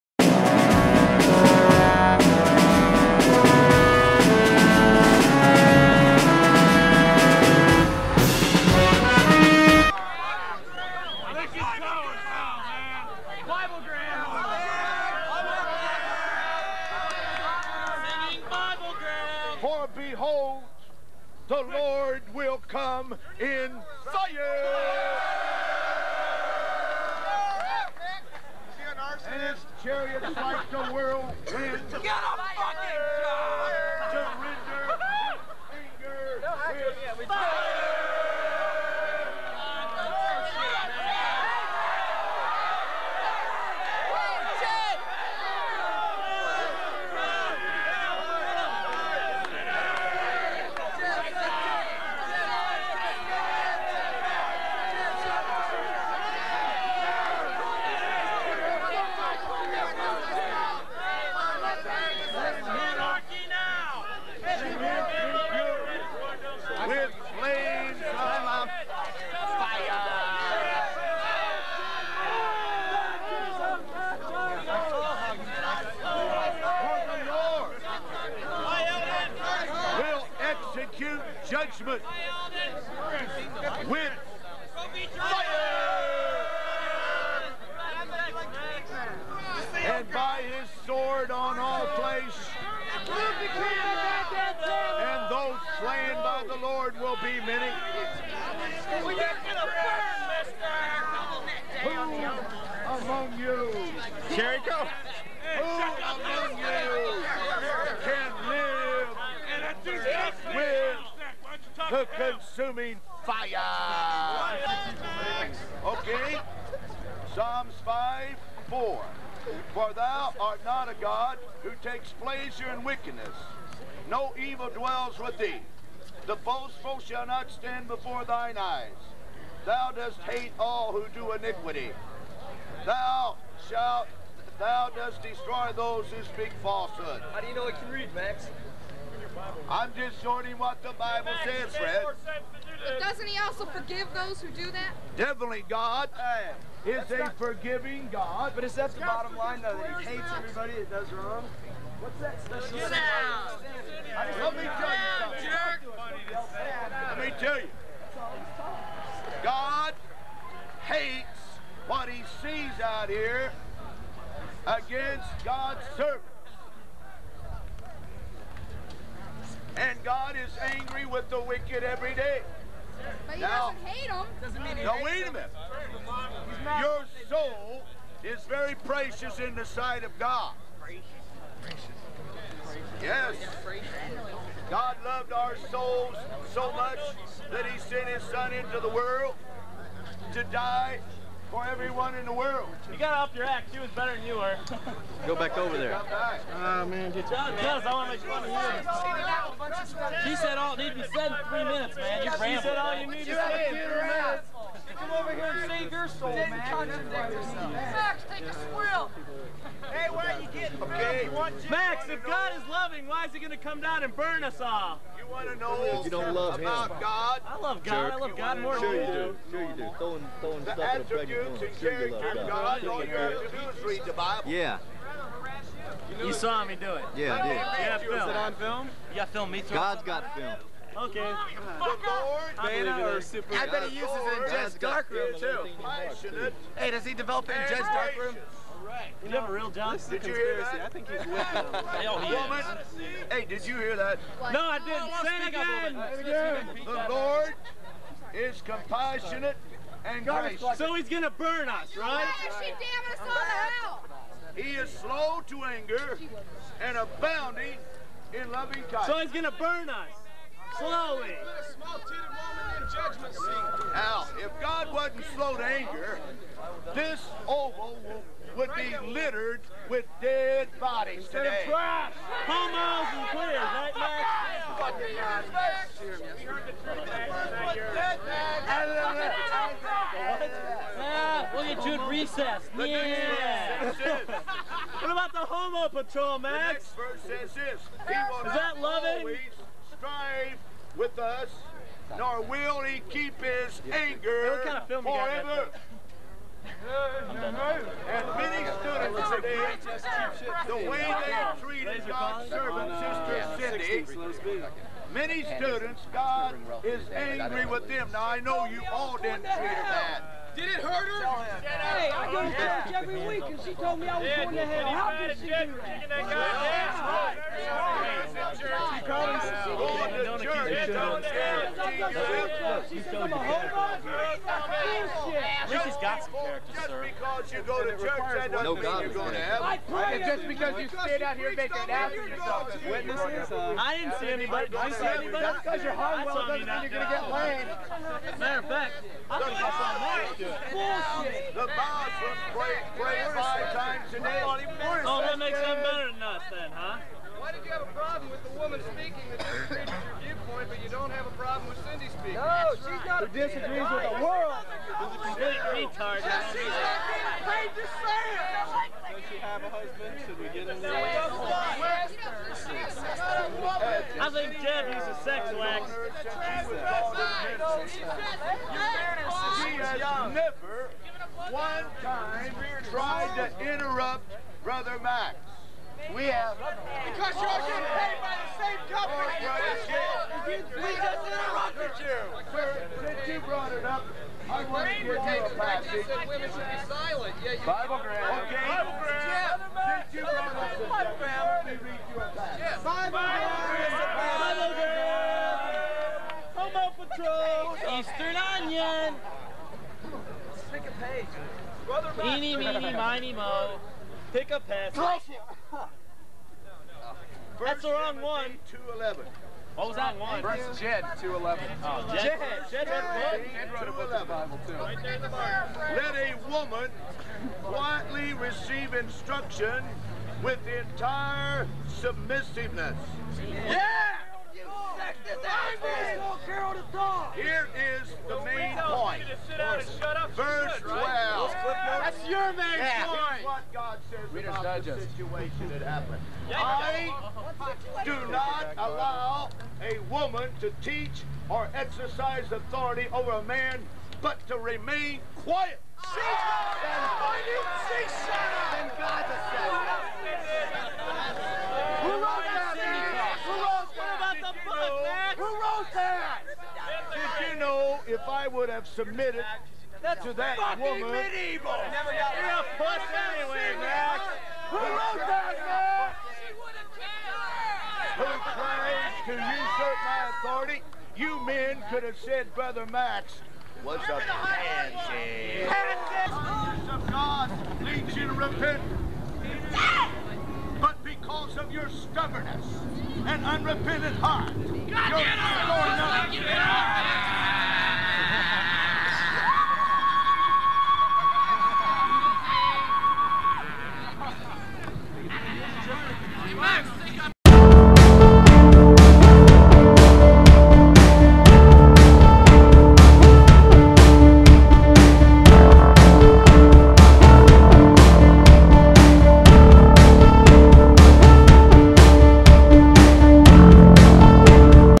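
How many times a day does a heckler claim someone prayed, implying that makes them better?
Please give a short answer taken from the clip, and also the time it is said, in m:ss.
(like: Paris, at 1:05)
5, at 5:43.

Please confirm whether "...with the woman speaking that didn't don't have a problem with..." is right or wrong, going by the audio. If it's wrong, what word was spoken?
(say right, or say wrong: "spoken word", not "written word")
right.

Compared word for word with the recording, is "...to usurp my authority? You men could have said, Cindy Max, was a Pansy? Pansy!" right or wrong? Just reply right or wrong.
wrong.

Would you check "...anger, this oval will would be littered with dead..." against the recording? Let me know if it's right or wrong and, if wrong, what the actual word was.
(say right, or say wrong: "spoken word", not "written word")
right.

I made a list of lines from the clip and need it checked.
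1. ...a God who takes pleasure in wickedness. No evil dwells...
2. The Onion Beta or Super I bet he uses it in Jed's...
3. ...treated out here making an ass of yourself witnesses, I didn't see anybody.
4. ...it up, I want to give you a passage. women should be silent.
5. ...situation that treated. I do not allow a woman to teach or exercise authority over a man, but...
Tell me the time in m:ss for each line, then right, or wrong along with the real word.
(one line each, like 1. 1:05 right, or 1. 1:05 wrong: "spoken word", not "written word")
1. 2:00 right
2. 3:51 wrong: "Lord", not "Onion"
3. 5:31 wrong: "stayed", not "treated"
4. 6:23 right
5. 7:15 wrong: "happened", not "treated".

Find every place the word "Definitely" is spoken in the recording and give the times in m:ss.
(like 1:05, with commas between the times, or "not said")
2:25.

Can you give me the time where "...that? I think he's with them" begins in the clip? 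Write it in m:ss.
4:00.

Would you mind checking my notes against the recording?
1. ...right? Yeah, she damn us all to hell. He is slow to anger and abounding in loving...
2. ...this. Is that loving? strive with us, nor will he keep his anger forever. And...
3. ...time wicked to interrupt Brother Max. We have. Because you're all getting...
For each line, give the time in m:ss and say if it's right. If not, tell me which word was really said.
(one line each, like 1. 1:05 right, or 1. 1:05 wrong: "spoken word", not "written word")
1. 4:11 right
2. 4:47 right
3. 6:12 wrong: "tried", not "wicked".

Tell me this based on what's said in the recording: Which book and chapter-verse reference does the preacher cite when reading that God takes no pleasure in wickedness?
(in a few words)
Psalms 5:4.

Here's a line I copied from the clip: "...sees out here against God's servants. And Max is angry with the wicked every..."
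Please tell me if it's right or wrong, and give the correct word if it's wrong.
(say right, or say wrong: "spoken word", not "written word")
wrong: "God", not "Max".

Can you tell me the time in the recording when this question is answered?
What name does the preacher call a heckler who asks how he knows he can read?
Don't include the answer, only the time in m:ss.
2:21.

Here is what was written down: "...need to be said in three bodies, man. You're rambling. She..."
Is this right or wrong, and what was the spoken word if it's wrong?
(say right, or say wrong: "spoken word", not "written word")
wrong: "minutes", not "bodies".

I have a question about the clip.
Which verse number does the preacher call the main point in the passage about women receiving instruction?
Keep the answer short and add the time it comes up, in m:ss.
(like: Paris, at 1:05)
12, at 7:10.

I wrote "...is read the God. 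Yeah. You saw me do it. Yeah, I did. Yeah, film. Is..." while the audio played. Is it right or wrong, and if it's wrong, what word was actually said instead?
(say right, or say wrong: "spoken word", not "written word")
wrong: "Bible", not "God".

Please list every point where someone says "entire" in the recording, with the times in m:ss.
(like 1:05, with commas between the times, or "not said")
7:00.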